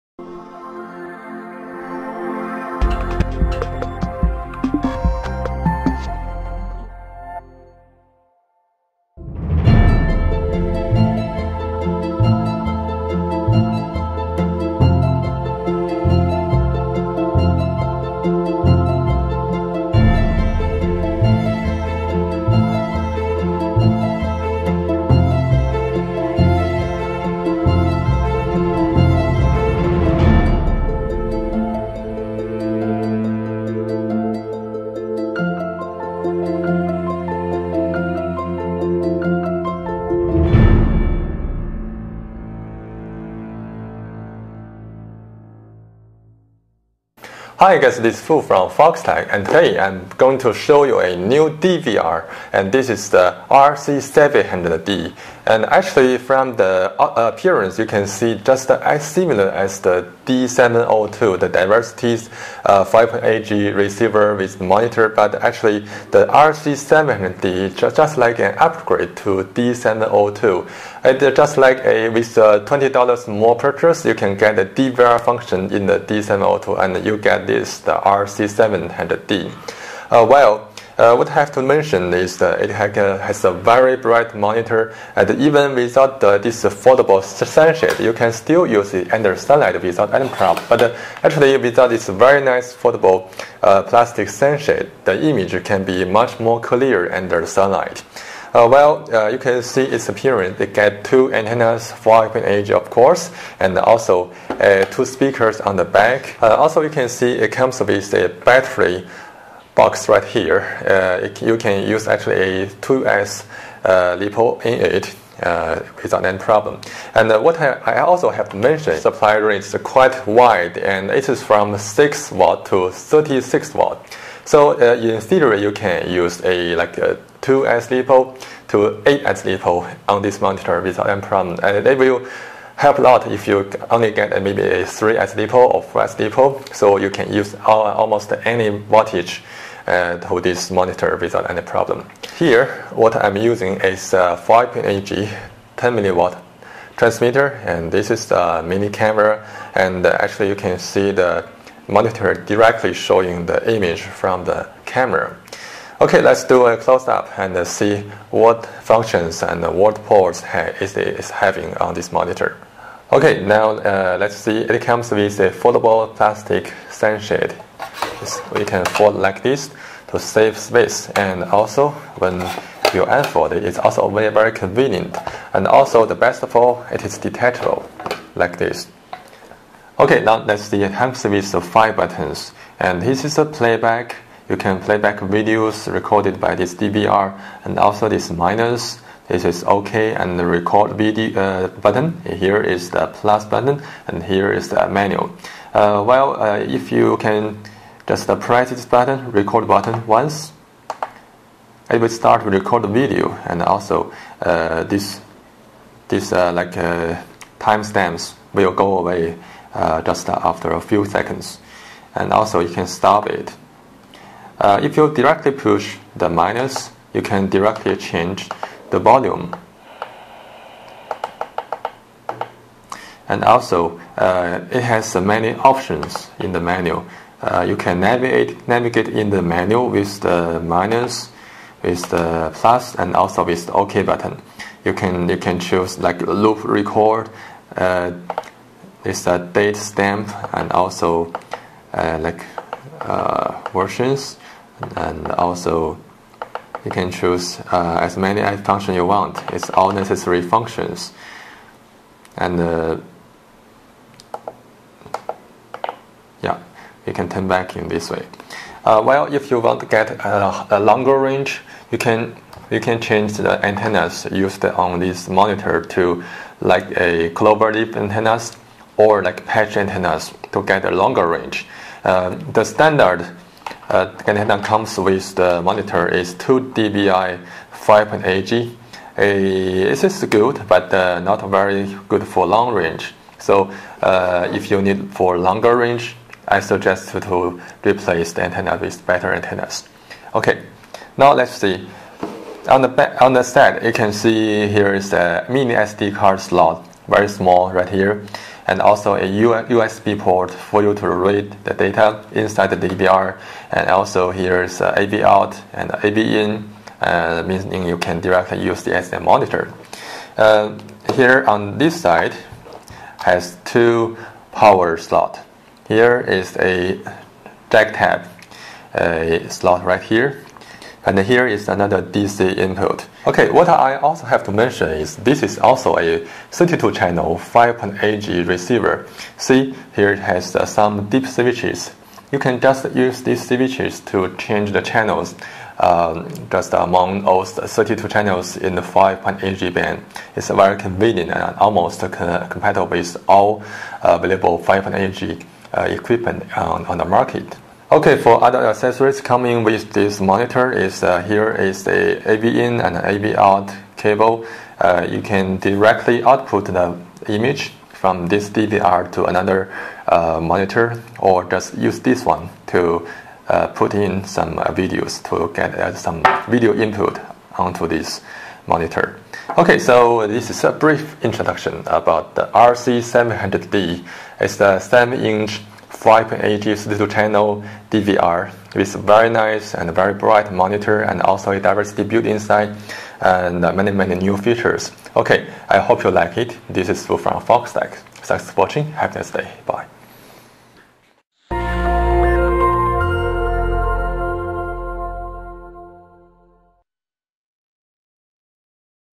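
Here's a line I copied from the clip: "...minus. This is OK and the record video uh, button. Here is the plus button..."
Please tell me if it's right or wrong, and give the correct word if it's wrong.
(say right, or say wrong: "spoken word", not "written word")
right.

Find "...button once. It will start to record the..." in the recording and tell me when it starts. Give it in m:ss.
3:19.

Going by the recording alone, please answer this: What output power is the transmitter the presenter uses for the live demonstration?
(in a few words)
10 milliwatt.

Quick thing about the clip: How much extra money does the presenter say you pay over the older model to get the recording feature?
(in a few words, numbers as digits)
$20.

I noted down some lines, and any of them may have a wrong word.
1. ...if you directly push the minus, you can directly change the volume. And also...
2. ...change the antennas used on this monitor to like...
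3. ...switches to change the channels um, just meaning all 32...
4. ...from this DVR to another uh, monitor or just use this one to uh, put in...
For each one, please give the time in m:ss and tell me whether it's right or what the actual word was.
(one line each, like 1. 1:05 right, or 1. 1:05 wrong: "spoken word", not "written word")
1. 3:34 right
2. 4:23 right
3. 5:33 wrong: "among", not "meaning"
4. 5:57 right.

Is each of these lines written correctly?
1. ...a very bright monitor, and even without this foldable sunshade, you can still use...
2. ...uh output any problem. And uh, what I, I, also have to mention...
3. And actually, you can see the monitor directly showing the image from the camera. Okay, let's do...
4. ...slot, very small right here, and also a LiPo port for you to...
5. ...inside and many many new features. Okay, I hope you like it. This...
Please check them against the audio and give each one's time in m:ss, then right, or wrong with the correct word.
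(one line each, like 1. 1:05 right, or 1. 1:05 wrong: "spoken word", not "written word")
1. 1:23 right
2. 1:55 wrong: "without", not "output"
3. 2:29 right
4. 4:56 wrong: "USB", not "LiPo"
5. 6:22 right.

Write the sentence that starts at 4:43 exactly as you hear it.
So uh, if you need for longer range, I suggest to replace the antenna with better antennas.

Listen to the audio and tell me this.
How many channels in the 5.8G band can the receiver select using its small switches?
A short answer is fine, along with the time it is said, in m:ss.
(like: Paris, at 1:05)
32, at 5:26.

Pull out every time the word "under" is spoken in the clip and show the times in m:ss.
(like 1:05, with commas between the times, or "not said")
1:29, 1:37.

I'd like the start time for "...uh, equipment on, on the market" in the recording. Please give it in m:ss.
5:45.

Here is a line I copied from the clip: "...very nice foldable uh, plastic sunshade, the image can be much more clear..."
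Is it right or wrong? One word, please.
right.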